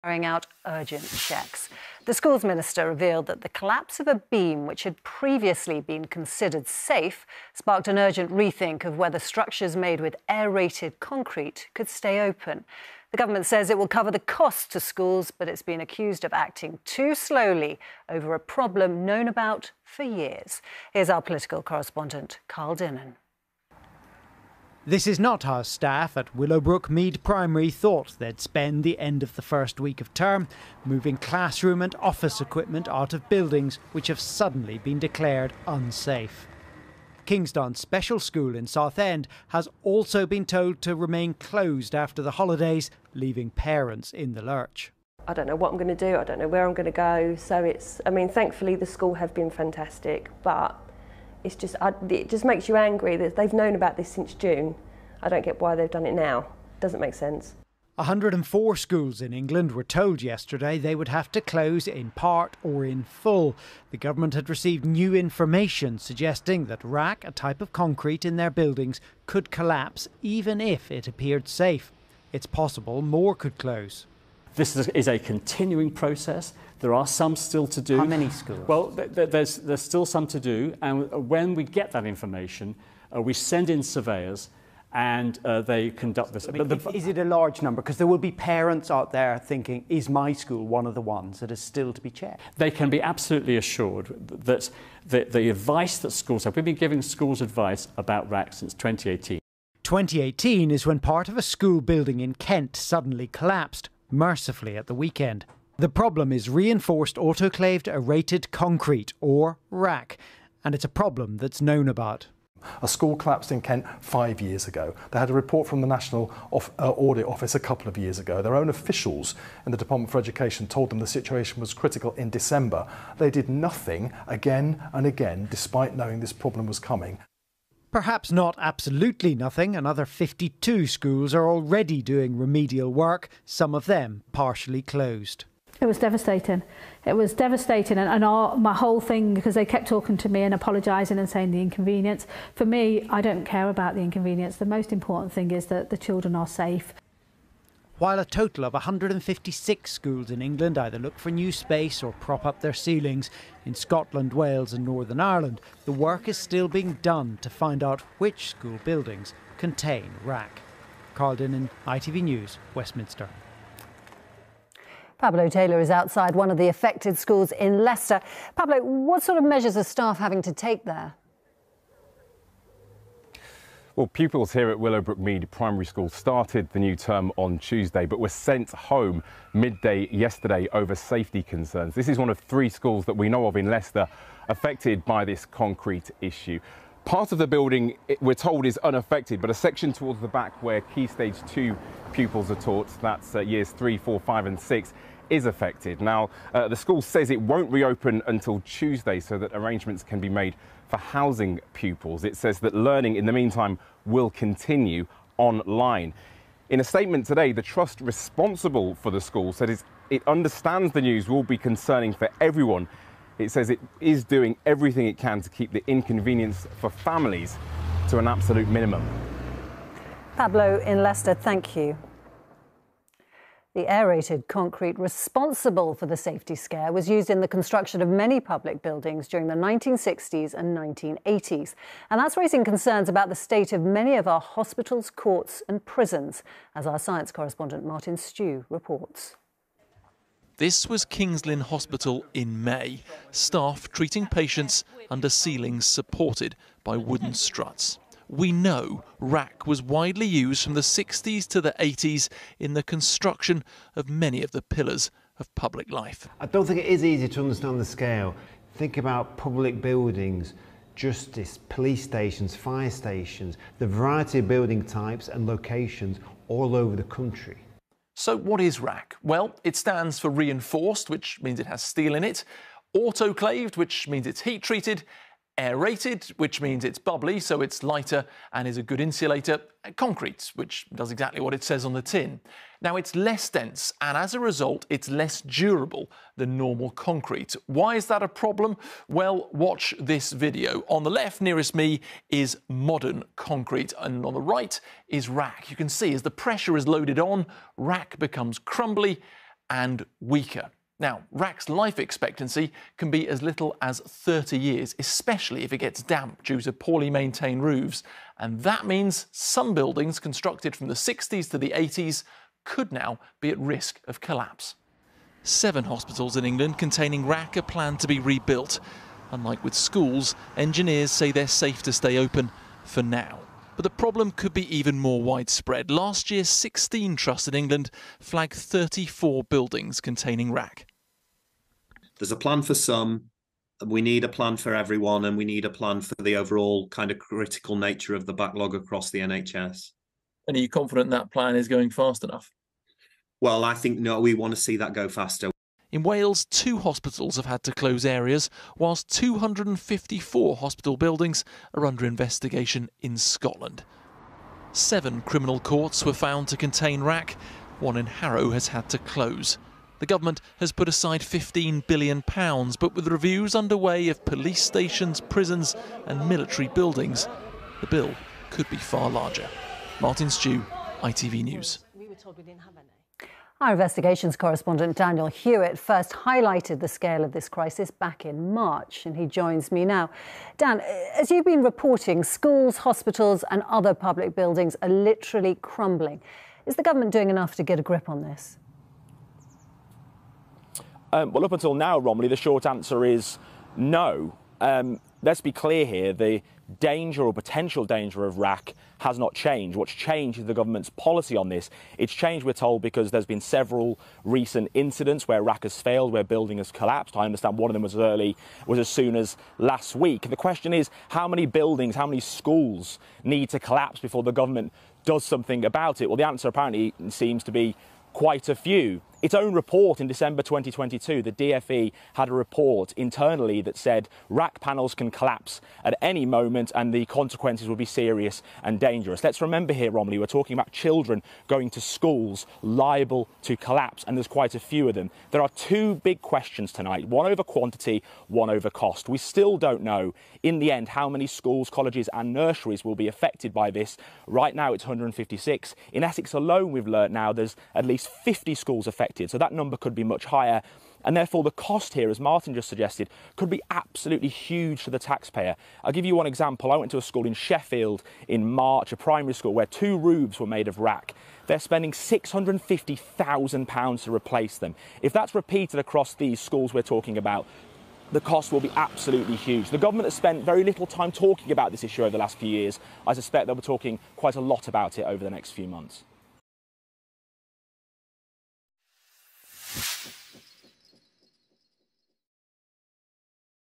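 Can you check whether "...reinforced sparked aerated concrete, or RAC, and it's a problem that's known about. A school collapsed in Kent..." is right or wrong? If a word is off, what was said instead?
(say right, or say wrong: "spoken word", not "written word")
wrong: "autoclaved", not "sparked".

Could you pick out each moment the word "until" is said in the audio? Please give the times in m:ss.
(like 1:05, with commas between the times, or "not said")
3:18, 6:31.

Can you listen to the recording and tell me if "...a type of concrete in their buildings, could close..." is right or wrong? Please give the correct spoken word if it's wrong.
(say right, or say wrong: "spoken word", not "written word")
wrong: "collapse", not "close".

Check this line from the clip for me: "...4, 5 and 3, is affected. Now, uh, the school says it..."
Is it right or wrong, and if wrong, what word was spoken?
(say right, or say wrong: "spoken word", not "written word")
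wrong: "6", not "3".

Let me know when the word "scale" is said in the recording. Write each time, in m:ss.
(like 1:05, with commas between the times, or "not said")
4:17, 6:16.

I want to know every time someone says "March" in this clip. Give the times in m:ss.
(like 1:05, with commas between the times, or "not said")
6:18, 7:38.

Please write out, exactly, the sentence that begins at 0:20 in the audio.
Here's our political correspondent, Carl Dinnen.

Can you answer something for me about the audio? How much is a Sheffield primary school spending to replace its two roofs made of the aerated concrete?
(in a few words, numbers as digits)
£650,000.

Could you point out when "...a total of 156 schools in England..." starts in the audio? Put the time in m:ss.
2:28.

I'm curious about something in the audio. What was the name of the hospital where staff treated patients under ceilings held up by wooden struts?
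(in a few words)
Kingsland Hospital.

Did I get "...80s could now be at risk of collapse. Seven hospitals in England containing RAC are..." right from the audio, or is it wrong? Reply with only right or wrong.
right.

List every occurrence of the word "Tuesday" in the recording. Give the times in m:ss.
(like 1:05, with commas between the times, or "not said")
2:57, 3:18.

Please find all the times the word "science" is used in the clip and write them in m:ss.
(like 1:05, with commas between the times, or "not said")
3:56.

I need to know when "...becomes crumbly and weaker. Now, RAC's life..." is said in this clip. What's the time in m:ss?
4:58.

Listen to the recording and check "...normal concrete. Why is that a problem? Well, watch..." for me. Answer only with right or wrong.
right.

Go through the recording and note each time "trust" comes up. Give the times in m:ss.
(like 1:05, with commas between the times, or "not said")
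3:27, 5:27.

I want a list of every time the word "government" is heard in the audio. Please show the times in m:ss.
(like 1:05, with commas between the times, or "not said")
0:13, 1:03, 6:00, 6:26, 6:40, 6:54, 7:49.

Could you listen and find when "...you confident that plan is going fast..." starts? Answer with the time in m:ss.
5:40.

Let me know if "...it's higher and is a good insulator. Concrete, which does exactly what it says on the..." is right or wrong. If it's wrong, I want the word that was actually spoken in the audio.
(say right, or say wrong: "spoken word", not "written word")
wrong: "lighter", not "higher".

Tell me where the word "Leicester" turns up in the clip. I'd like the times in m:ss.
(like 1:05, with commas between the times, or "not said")
2:47, 3:03, 3:41.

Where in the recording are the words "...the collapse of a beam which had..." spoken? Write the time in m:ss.
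0:03.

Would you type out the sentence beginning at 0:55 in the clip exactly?
I don't get why they've done it now.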